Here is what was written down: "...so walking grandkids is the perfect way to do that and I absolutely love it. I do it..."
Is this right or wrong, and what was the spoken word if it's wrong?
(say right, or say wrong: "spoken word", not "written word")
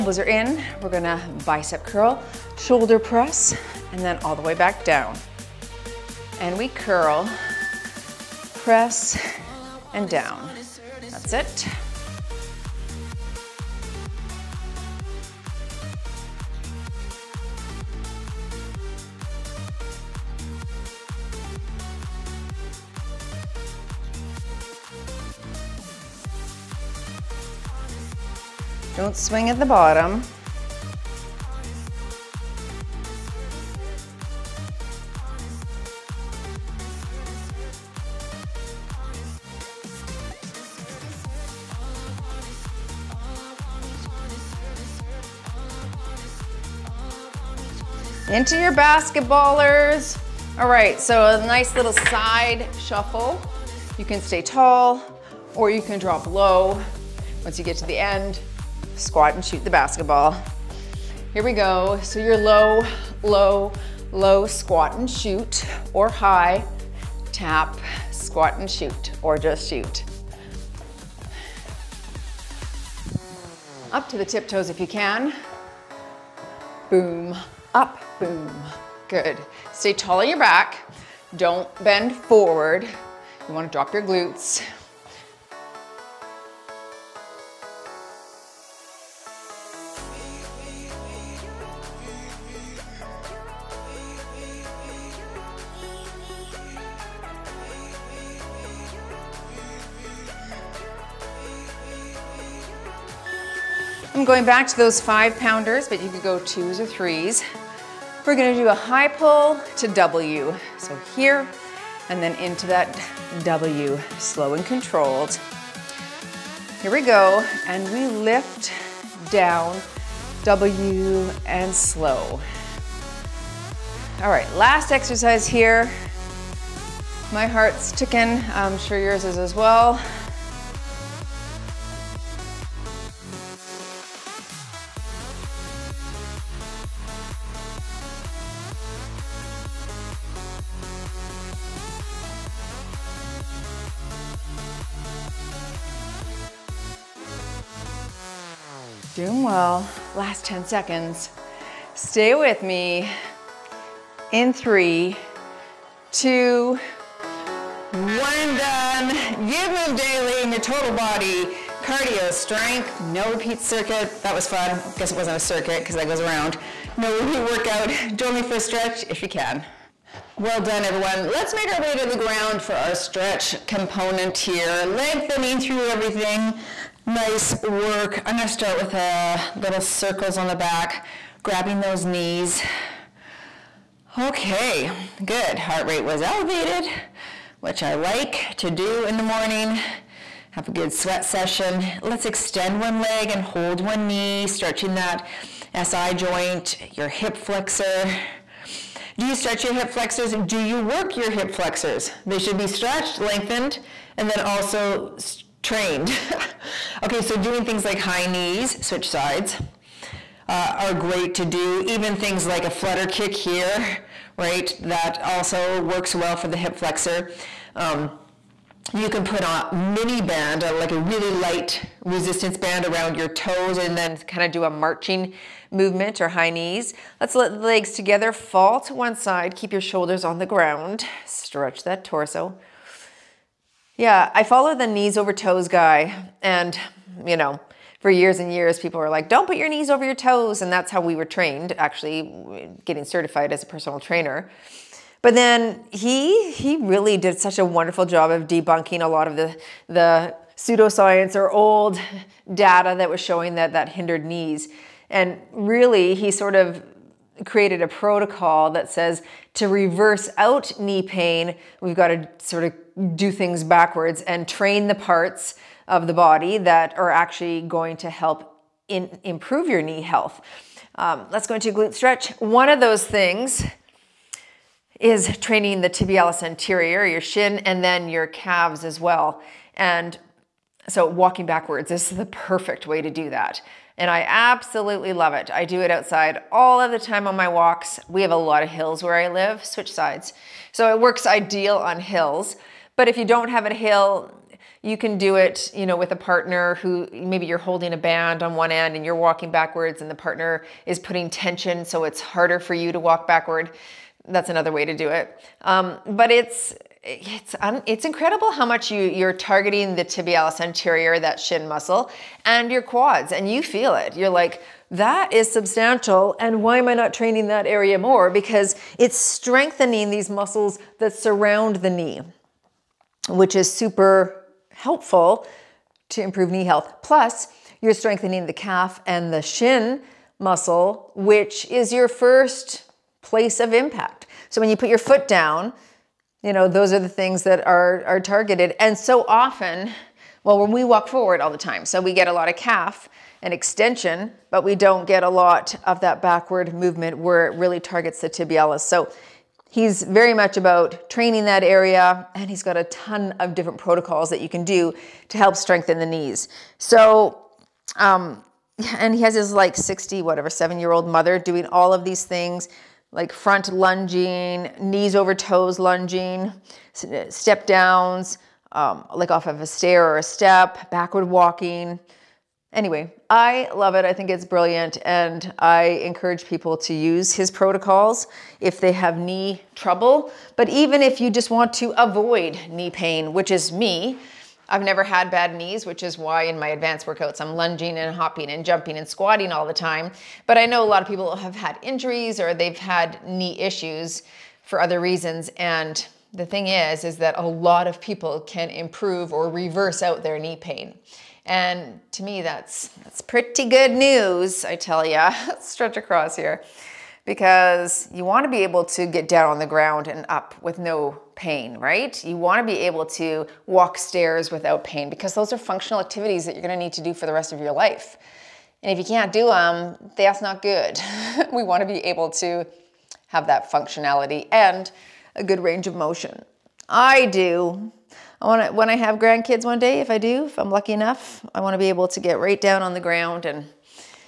wrong: "backwards", not "grandkids".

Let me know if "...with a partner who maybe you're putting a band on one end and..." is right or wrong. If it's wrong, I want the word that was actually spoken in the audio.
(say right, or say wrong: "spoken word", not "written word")
wrong: "holding", not "putting".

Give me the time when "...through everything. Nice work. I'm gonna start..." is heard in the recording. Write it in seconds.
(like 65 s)
175 s.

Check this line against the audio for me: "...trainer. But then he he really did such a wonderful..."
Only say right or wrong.
right.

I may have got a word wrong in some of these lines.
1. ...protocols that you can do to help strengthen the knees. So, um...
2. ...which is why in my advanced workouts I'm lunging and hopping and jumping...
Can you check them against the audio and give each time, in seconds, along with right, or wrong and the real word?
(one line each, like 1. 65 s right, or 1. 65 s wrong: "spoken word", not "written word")
1. 353 s right
2. 385 s right.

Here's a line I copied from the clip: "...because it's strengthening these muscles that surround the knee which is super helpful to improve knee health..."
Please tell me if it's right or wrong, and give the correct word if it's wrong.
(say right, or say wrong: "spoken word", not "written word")
right.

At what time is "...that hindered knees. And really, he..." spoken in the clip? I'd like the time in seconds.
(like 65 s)
253 s.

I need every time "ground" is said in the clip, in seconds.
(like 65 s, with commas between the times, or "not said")
172 s, 230 s, 409 s, 432 s.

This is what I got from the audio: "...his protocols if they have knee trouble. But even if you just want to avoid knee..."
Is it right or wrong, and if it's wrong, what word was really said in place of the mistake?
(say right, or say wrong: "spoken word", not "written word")
right.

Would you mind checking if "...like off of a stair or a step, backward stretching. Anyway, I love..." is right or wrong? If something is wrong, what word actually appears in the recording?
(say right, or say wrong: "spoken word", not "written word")
wrong: "walking", not "stretching".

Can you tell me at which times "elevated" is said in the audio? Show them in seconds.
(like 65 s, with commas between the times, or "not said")
186 s.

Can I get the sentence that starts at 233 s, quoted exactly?
Yeah, I follow the knees over toes guy.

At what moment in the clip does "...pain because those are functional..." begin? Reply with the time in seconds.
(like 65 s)
414 s.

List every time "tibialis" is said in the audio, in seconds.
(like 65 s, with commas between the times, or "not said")
275 s, 310 s, 348 s.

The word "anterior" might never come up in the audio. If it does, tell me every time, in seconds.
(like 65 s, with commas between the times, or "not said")
276 s, 310 s.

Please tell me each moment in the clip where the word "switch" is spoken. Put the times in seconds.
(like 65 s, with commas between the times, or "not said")
208 s, 289 s.